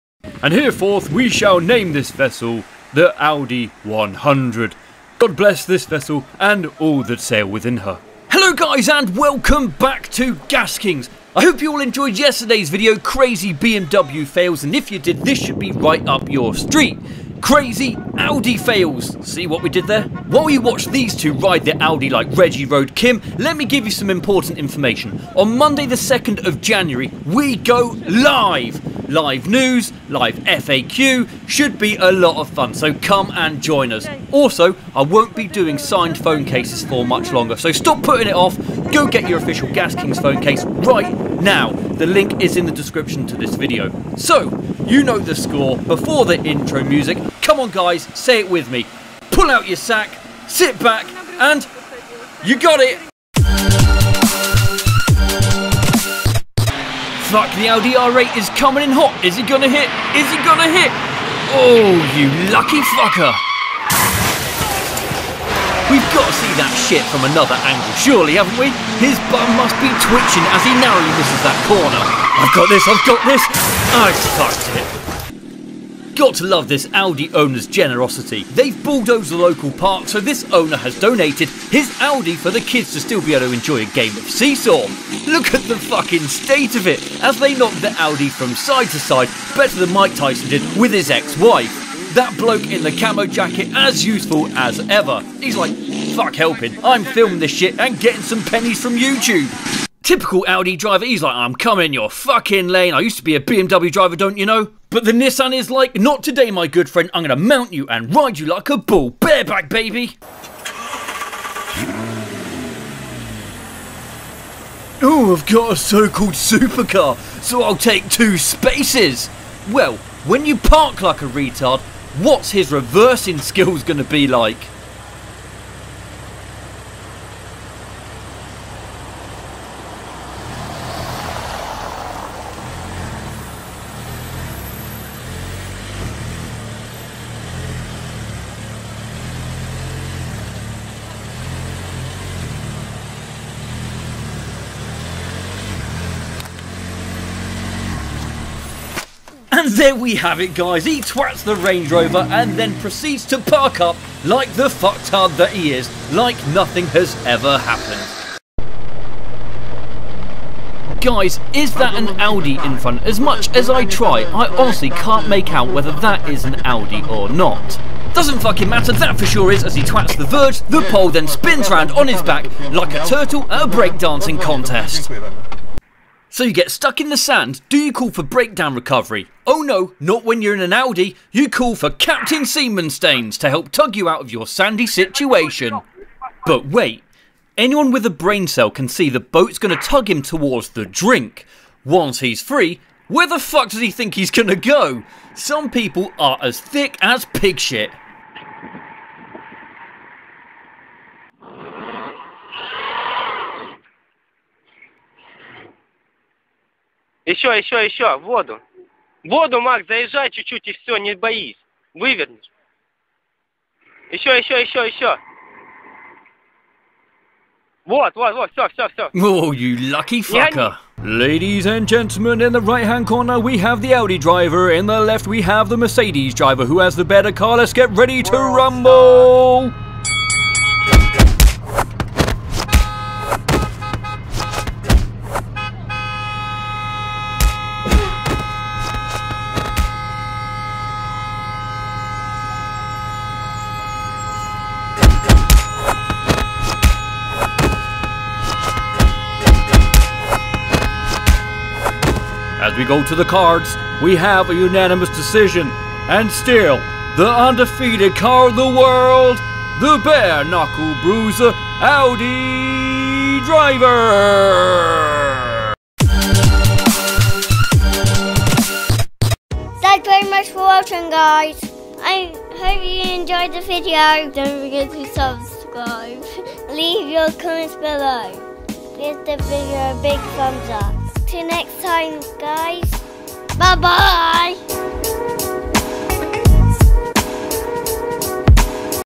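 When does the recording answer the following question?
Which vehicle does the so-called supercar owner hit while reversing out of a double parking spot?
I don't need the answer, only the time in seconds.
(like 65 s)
151 s.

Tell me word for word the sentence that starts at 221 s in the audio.
Ladies and gentlemen, in the right-hand corner we have the Audi driver, in the left we have the Mercedes driver.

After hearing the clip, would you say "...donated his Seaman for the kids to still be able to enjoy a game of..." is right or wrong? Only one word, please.
wrong.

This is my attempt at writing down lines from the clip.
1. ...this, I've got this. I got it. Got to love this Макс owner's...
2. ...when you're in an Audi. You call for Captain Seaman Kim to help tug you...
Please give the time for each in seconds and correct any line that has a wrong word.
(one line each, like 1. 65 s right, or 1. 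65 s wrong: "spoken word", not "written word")
1. 72 s wrong: "Audi", not "Макс"
2. 180 s wrong: "Stains", not "Kim".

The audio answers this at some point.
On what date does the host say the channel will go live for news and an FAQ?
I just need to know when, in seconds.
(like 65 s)
25 s.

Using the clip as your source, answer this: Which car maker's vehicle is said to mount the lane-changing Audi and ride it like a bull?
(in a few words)
Nissan.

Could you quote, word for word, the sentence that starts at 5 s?
God bless this vessel and all that sail within her.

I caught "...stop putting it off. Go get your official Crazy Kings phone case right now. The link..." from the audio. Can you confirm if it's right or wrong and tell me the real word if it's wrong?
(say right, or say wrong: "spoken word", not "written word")
wrong: "Gas", not "Crazy".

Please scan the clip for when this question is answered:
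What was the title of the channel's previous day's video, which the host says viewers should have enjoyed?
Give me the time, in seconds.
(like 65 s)
12 s.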